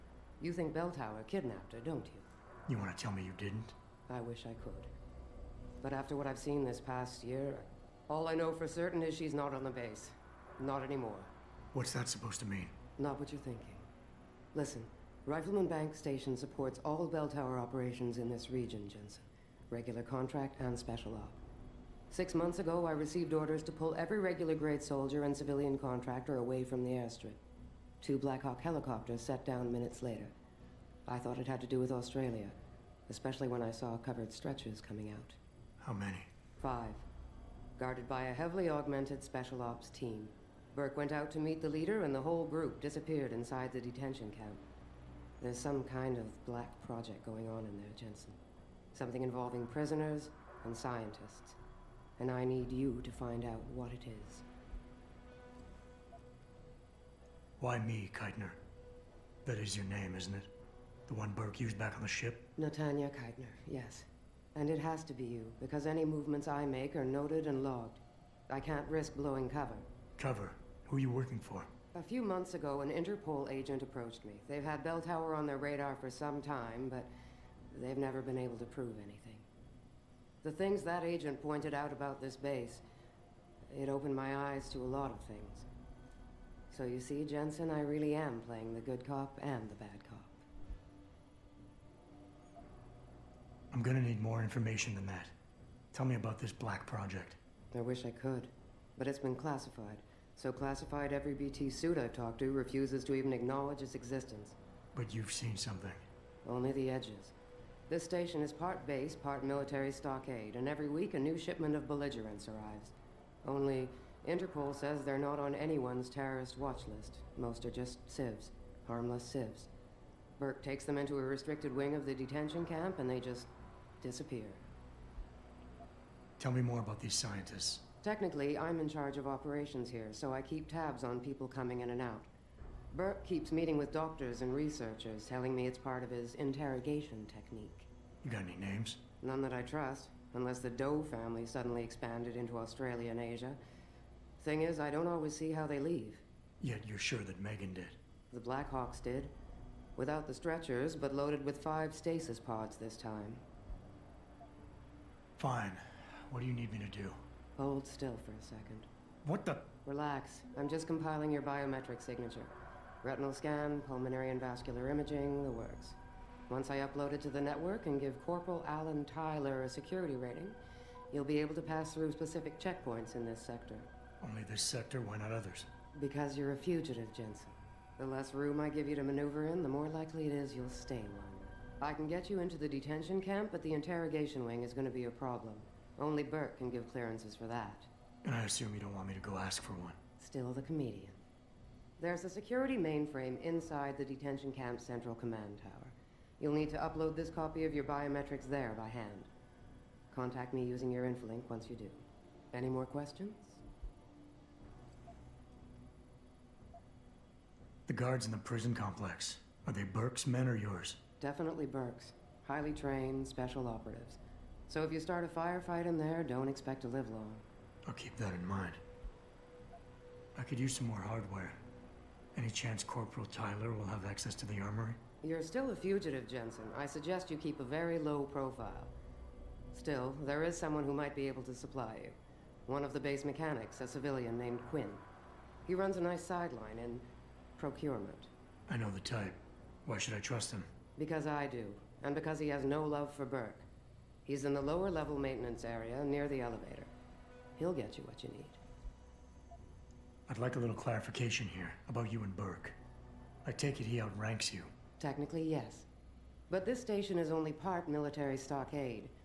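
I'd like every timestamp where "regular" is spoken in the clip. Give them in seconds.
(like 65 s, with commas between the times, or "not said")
19 s, 24 s.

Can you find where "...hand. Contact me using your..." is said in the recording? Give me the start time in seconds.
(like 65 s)
198 s.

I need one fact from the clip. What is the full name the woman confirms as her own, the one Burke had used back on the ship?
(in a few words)
Netanya Keitner.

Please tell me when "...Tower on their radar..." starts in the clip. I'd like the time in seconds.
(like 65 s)
75 s.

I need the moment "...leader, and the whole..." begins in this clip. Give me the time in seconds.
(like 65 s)
41 s.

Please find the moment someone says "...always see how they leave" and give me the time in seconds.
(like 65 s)
145 s.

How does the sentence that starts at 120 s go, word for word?
Burke takes them into a restricted wing of the detention camp, and they just disappear.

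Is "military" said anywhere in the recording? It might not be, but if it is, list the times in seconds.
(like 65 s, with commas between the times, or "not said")
109 s, 257 s.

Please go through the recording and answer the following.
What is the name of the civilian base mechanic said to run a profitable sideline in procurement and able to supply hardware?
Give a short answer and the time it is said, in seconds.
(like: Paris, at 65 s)
Quinn, at 234 s.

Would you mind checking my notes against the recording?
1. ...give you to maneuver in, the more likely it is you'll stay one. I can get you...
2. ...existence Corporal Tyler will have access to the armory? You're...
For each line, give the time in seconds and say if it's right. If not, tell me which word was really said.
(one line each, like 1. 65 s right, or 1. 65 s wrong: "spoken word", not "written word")
1. 178 s right
2. 222 s wrong: "chance", not "existence".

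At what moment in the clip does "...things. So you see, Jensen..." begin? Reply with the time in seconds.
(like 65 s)
85 s.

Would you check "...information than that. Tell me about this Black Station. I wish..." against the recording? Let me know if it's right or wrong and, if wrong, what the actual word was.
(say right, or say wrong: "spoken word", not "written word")
wrong: "Project", not "Station".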